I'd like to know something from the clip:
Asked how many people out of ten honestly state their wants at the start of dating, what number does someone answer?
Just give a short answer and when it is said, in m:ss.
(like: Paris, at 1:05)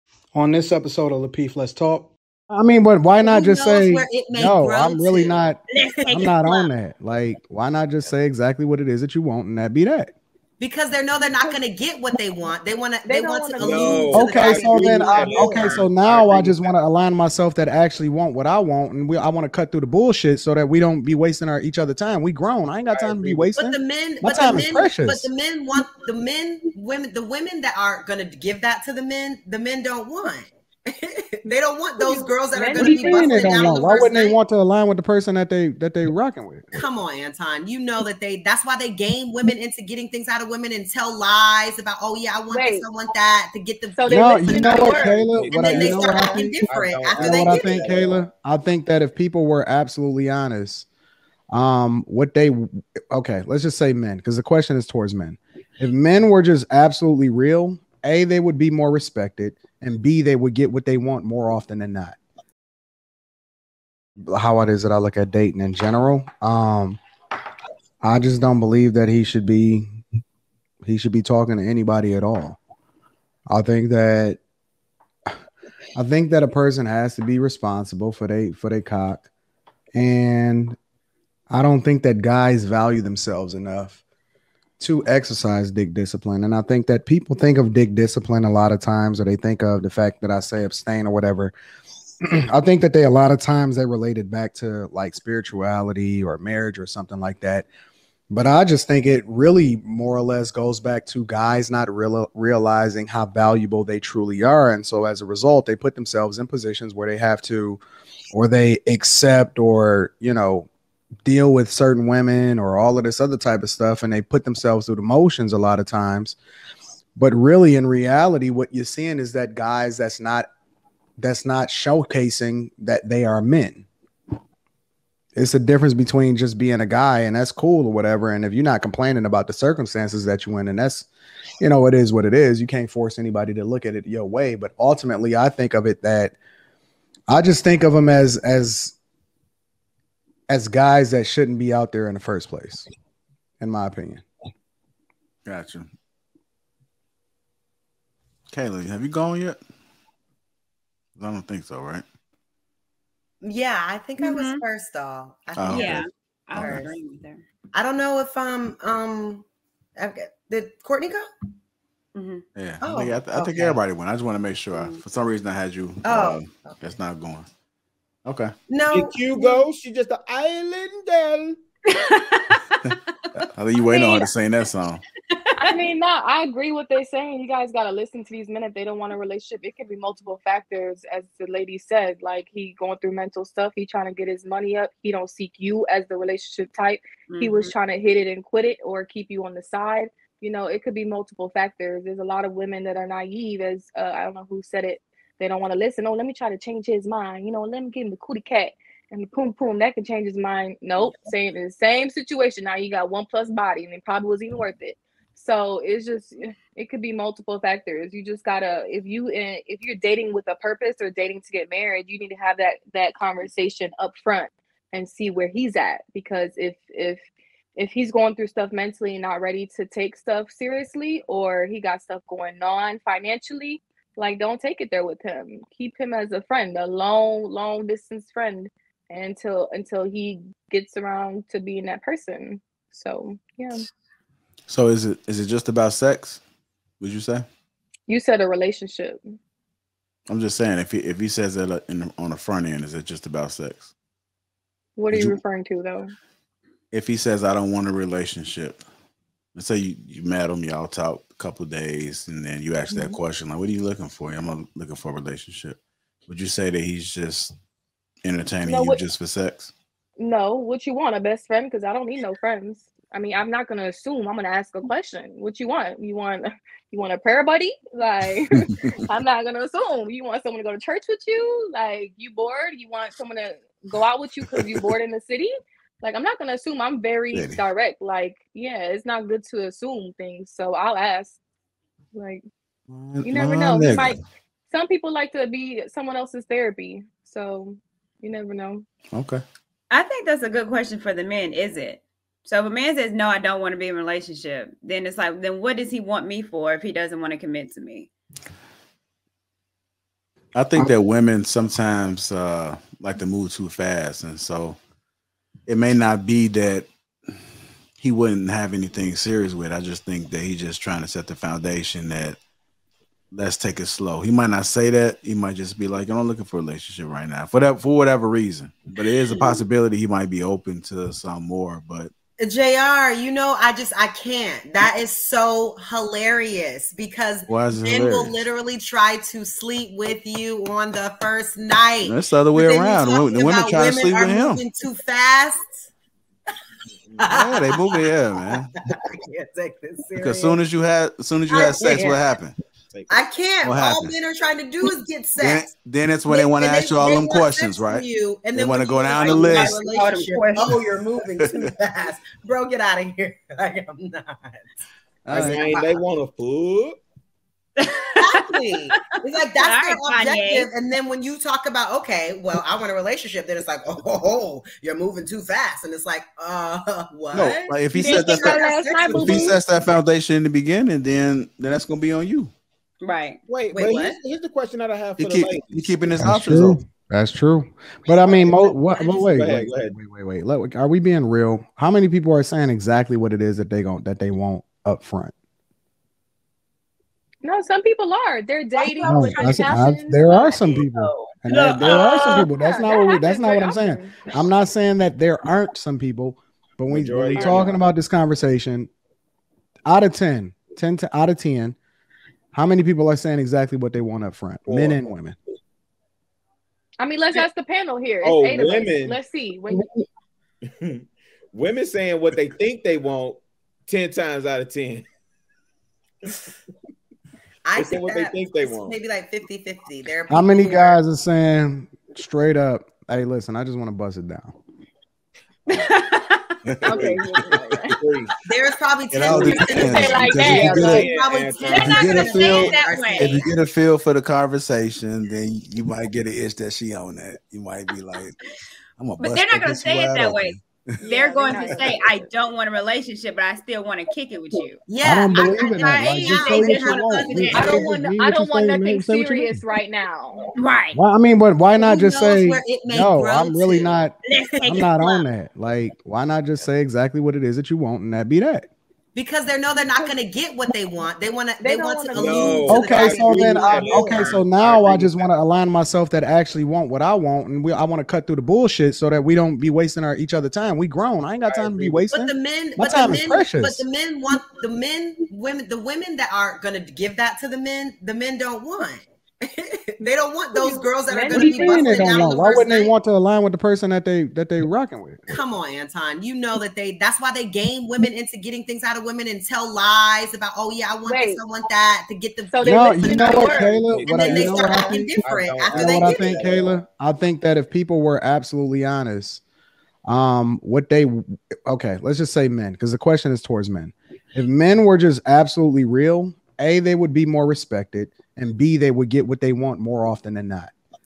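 4, at 6:44.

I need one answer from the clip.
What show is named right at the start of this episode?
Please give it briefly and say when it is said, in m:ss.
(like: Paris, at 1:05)
Lapeef Let's Talk, at 0:01.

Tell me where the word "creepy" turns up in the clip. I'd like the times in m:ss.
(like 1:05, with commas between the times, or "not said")
not said.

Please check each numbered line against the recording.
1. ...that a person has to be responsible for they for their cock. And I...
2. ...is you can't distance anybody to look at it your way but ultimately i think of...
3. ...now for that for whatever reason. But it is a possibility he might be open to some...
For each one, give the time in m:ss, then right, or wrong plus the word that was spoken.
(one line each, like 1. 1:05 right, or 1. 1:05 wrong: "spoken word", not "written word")
1. 1:16 right
2. 2:12 wrong: "force", not "distance"
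3. 5:17 right.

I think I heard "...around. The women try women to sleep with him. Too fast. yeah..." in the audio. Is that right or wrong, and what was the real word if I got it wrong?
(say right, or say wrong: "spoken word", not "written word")
right.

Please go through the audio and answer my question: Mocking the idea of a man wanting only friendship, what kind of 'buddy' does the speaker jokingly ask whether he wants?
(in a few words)
prayer buddy.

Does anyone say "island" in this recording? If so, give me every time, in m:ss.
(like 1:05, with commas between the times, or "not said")
2:50.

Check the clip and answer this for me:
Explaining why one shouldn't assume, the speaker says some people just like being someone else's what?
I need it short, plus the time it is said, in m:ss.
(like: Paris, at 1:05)
therapy, at 4:46.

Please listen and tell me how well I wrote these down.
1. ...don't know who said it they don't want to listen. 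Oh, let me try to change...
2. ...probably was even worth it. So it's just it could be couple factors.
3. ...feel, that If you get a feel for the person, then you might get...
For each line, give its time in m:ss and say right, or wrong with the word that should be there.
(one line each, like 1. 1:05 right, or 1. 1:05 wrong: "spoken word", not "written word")
1. 3:14 right
2. 3:24 wrong: "multiple", not "couple"
3. 7:12 wrong: "conversation", not "person".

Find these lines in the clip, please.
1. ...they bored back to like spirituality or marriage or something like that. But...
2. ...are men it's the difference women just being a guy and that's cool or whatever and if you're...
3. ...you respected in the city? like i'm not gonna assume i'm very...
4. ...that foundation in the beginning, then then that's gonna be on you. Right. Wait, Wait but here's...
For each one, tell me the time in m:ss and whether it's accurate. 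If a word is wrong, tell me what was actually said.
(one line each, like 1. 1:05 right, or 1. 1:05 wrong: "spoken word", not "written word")
1. 1:33 wrong: "related", not "bored"
2. 2:03 wrong: "between", not "women"
3. 4:34 wrong: "bored", not "respected"
4. 6:09 right.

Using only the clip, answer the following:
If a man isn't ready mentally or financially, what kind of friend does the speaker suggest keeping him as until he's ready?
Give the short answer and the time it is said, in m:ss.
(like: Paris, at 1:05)
long distance friend, at 3:47.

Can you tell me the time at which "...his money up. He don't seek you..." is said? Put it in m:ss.
3:04.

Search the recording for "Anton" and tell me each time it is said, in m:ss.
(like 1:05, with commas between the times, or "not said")
0:37, 8:05.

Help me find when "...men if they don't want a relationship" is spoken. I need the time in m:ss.
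2:58.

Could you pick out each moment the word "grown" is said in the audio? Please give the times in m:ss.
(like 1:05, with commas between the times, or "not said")
0:22, 7:50.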